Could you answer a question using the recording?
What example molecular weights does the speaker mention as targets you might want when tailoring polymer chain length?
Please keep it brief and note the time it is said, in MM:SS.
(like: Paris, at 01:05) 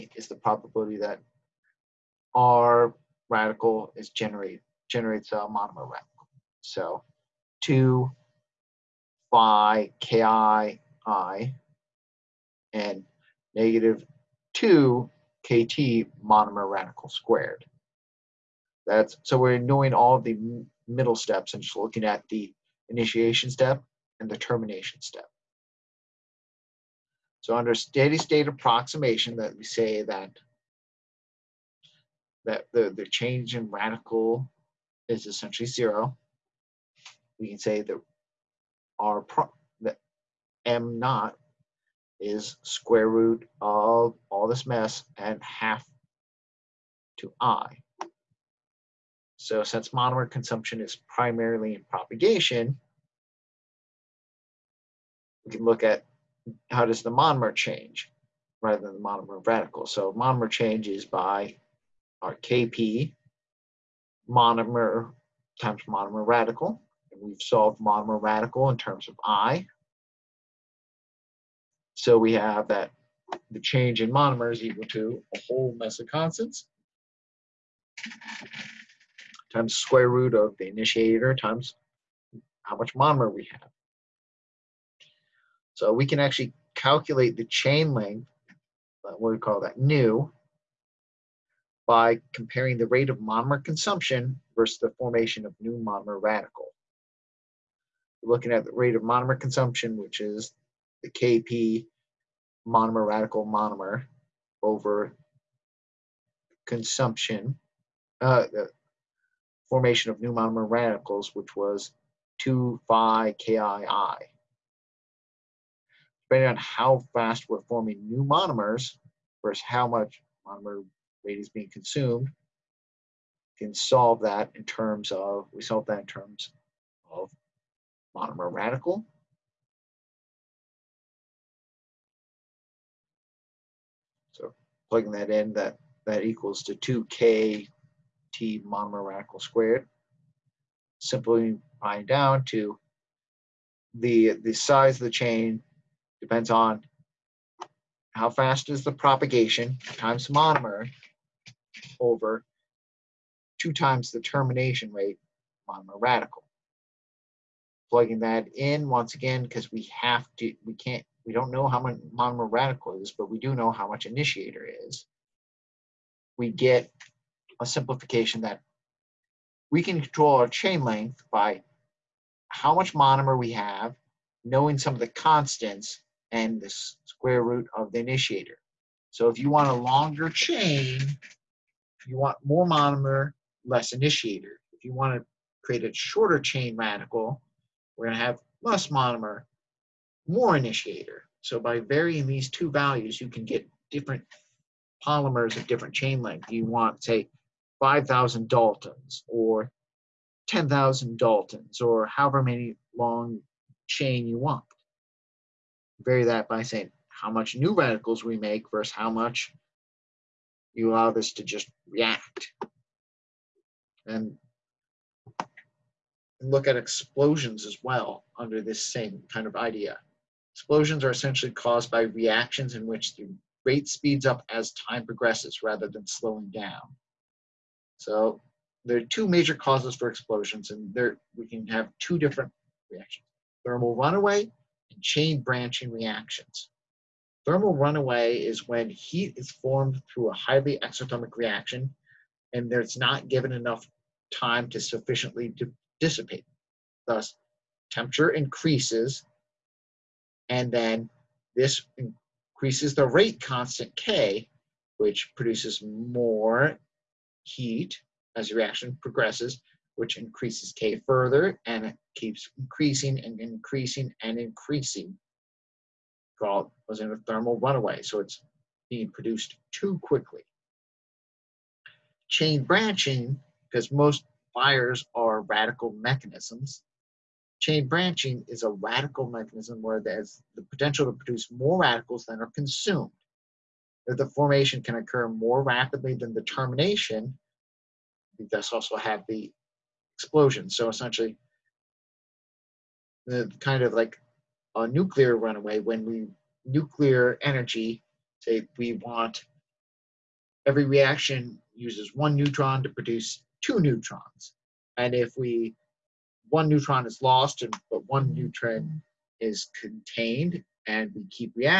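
5,000 or 10,000 Daltons, at 03:17.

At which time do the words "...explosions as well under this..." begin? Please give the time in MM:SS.
03:36.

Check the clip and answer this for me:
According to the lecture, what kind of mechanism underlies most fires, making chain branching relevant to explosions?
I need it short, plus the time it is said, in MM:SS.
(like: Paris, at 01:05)
Radical mechanisms, at 04:35.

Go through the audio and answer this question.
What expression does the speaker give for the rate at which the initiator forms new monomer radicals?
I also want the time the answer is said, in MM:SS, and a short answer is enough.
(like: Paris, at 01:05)
2 phi ki, at 01:52.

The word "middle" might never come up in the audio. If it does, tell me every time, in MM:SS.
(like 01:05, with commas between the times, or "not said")
00:20.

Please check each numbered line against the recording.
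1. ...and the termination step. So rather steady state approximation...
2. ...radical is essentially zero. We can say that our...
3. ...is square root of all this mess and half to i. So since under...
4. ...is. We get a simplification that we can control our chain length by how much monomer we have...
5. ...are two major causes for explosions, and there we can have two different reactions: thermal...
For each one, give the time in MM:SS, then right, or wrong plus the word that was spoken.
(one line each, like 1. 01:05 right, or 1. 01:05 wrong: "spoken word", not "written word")
1. 00:24 wrong: "under", not "rather"
2. 00:33 right
3. 00:42 wrong: "monomer", not "under"
4. 02:44 right
5. 03:48 right.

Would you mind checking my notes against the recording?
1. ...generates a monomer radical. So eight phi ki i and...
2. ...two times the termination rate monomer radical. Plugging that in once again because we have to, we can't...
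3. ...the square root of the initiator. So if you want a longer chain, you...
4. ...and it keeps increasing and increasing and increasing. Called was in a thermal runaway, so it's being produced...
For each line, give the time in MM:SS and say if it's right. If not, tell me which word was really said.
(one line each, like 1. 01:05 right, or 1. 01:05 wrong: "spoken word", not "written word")
1. 00:04 wrong: "two", not "eight"
2. 02:33 right
3. 02:56 right
4. 04:21 right.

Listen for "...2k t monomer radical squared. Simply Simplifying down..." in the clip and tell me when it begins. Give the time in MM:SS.
02:16.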